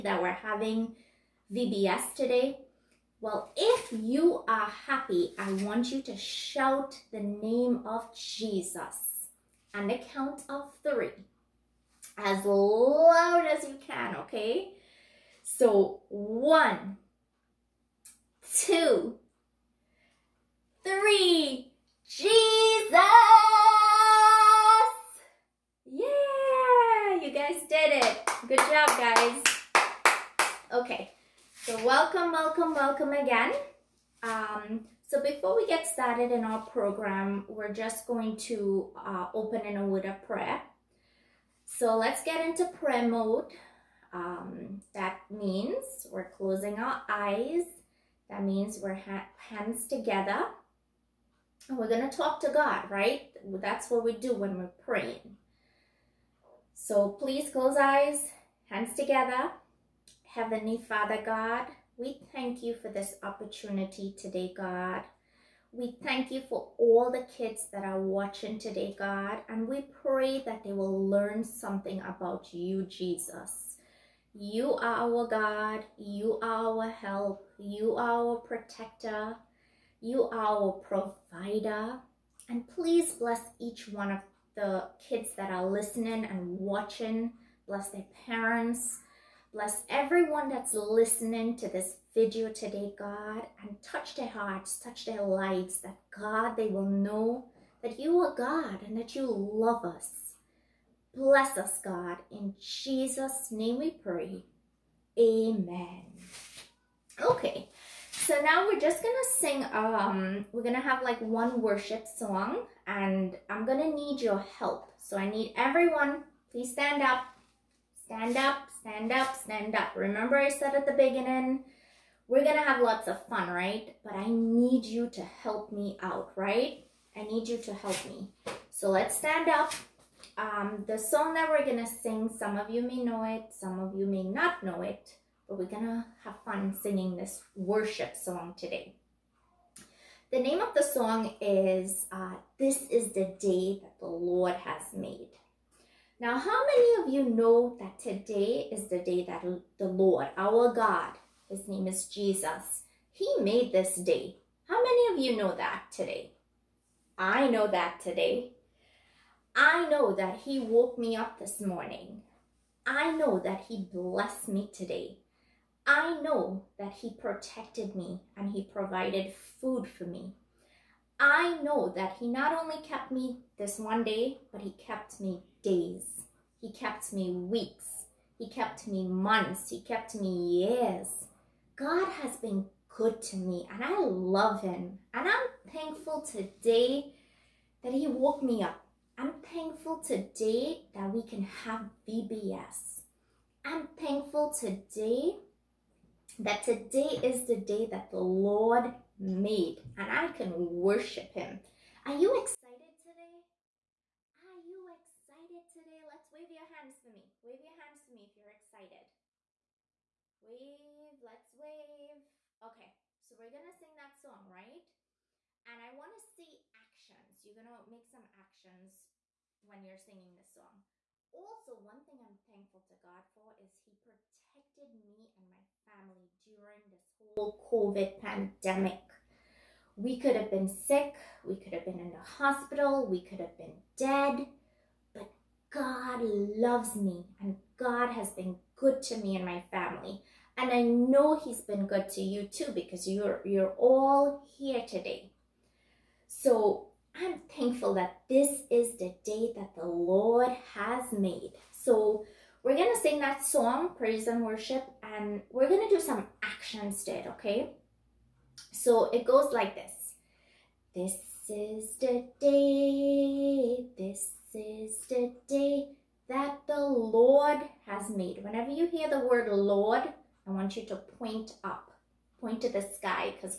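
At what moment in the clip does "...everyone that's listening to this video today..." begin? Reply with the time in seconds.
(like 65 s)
89 s.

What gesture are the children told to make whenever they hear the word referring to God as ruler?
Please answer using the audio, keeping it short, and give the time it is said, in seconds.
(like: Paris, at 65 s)
Point up, at 270 s.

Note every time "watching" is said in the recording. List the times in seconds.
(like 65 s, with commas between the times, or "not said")
68 s, 86 s.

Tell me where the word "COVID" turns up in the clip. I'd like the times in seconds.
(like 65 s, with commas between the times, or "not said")
227 s.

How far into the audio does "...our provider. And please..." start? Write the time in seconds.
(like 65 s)
80 s.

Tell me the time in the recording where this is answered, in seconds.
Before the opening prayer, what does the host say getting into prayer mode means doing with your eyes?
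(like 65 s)
46 s.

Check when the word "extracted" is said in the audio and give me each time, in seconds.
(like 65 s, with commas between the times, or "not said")
not said.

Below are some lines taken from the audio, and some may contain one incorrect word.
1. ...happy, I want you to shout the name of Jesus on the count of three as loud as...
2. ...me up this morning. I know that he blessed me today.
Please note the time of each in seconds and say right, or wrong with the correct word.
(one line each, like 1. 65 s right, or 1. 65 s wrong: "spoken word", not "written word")
1. 4 s right
2. 160 s right.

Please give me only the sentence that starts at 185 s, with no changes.
And I'm thankful today that He woke me up.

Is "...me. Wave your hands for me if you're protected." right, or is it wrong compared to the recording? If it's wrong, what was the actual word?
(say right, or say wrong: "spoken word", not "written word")
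wrong: "excited", not "protected".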